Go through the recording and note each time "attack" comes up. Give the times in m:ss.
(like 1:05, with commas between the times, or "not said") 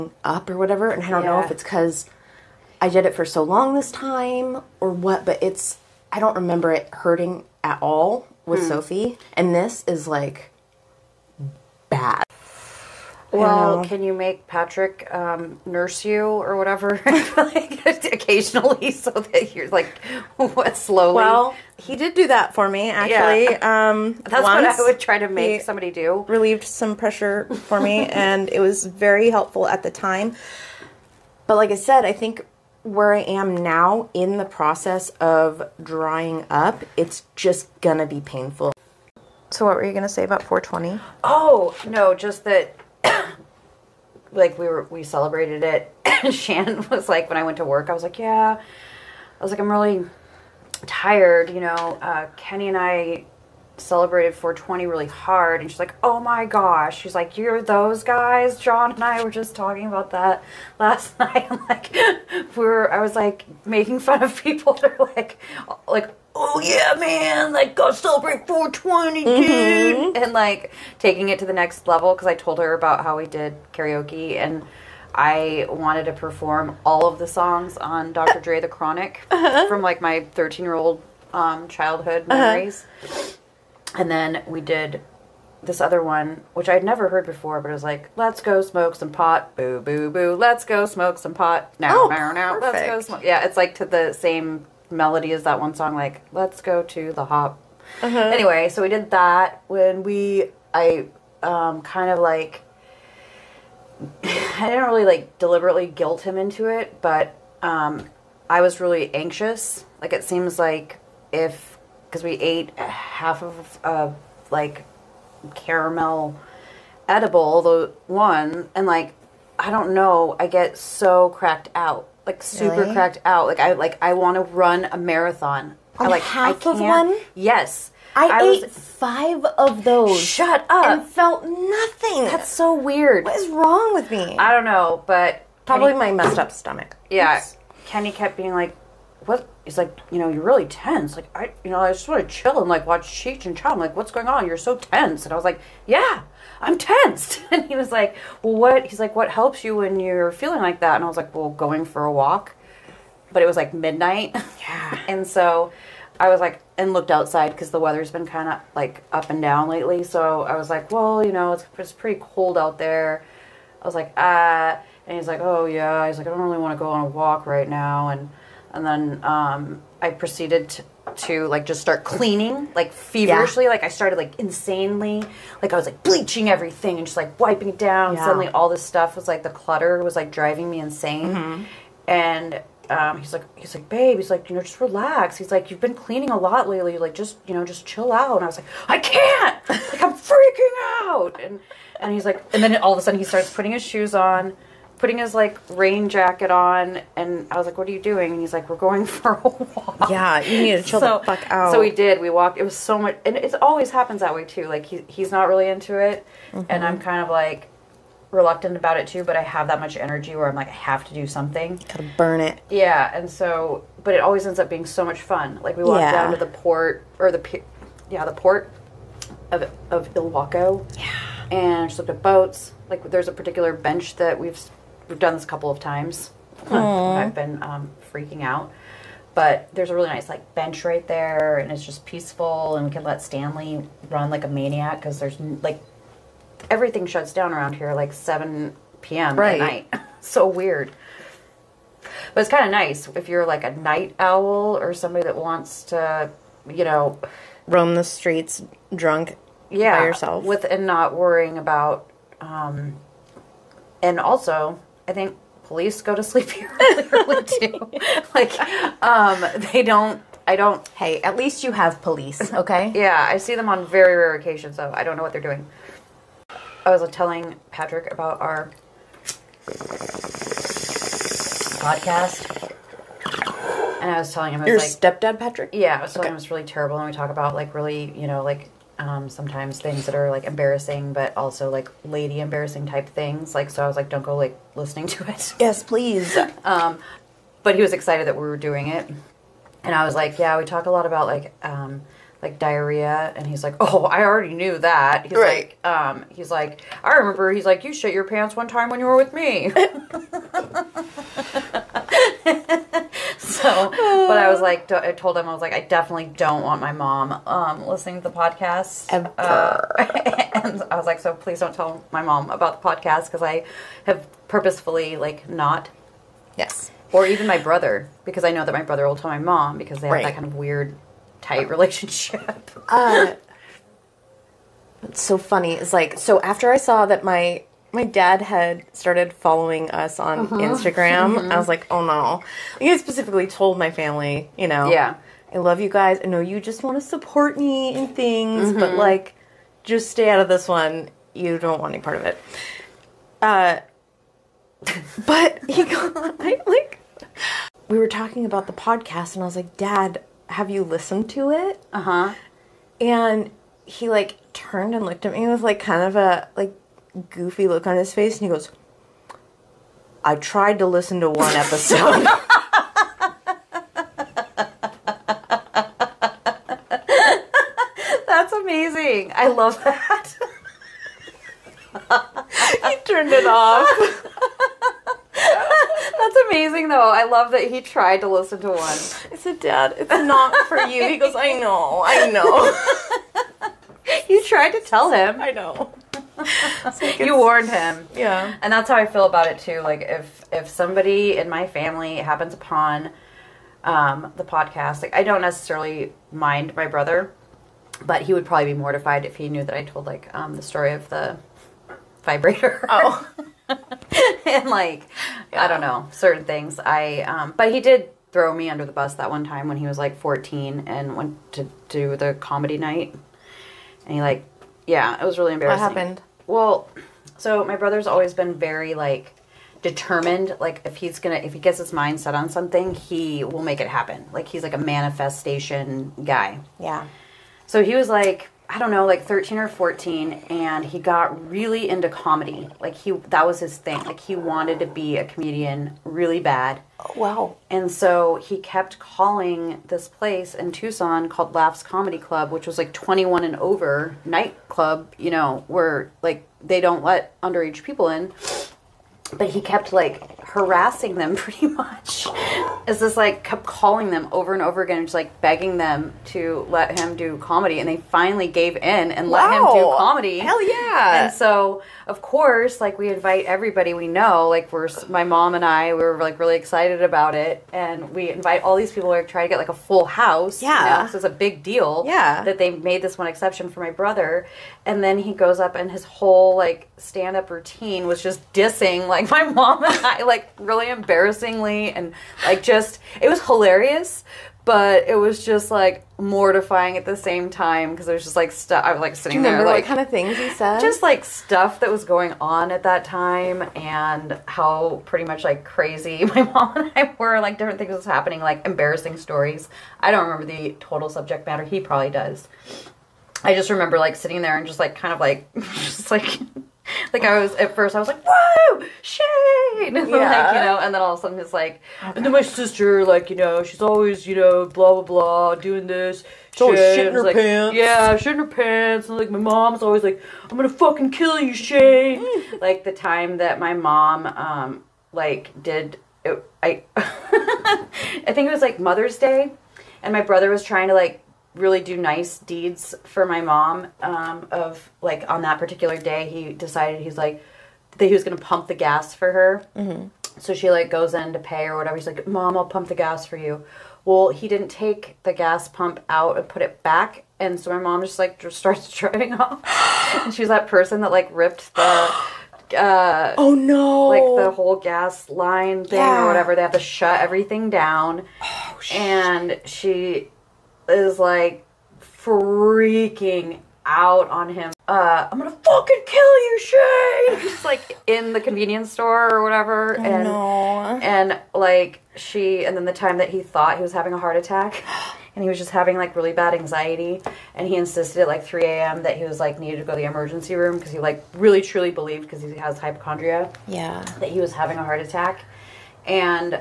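9:34, 9:45.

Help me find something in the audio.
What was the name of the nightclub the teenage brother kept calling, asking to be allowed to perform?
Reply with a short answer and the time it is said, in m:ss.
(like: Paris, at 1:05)
Laughs Comedy Club, at 7:21.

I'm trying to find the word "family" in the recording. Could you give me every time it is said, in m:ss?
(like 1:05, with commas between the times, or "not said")
5:33, 6:31.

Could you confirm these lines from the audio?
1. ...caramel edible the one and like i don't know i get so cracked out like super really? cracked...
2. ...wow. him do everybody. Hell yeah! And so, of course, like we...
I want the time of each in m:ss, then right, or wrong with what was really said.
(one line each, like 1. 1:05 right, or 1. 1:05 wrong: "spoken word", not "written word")
1. 1:55 right
2. 7:39 wrong: "comedy", not "everybody".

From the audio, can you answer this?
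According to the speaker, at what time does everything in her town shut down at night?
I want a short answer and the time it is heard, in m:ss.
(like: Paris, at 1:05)
7 p.m., at 3:58.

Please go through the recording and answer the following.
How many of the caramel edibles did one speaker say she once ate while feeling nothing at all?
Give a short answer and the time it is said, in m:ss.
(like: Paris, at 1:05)
5, at 2:08.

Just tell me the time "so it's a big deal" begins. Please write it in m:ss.
7:51.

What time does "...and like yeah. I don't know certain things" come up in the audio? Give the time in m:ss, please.
6:44.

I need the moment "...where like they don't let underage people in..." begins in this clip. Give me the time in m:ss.
7:25.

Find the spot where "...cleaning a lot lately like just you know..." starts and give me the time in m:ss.
3:05.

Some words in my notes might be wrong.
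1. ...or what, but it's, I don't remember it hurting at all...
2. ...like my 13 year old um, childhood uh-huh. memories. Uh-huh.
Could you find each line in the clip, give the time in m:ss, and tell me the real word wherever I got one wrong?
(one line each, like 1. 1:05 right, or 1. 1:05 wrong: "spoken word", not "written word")
1. 0:04 right
2. 1:19 right.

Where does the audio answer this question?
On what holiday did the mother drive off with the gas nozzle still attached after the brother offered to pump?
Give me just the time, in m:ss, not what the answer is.
8:48.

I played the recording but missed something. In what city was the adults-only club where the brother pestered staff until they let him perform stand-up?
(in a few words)
Tucson.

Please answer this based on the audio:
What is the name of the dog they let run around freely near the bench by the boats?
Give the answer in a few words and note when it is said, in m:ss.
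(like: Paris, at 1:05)
Stanley, at 3:53.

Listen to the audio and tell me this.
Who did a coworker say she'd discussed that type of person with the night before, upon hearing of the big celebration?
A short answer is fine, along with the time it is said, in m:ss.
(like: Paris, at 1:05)
John, at 0:58.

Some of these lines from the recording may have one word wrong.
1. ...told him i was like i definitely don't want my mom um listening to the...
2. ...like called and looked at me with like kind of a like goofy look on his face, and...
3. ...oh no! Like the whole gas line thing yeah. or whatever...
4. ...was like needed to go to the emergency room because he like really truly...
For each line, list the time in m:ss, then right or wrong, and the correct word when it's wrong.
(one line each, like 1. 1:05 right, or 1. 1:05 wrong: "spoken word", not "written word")
1. 5:05 right
2. 5:54 wrong: "turned", not "called"
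3. 9:13 right
4. 9:39 right.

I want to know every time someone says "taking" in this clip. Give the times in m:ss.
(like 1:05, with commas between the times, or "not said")
1:10.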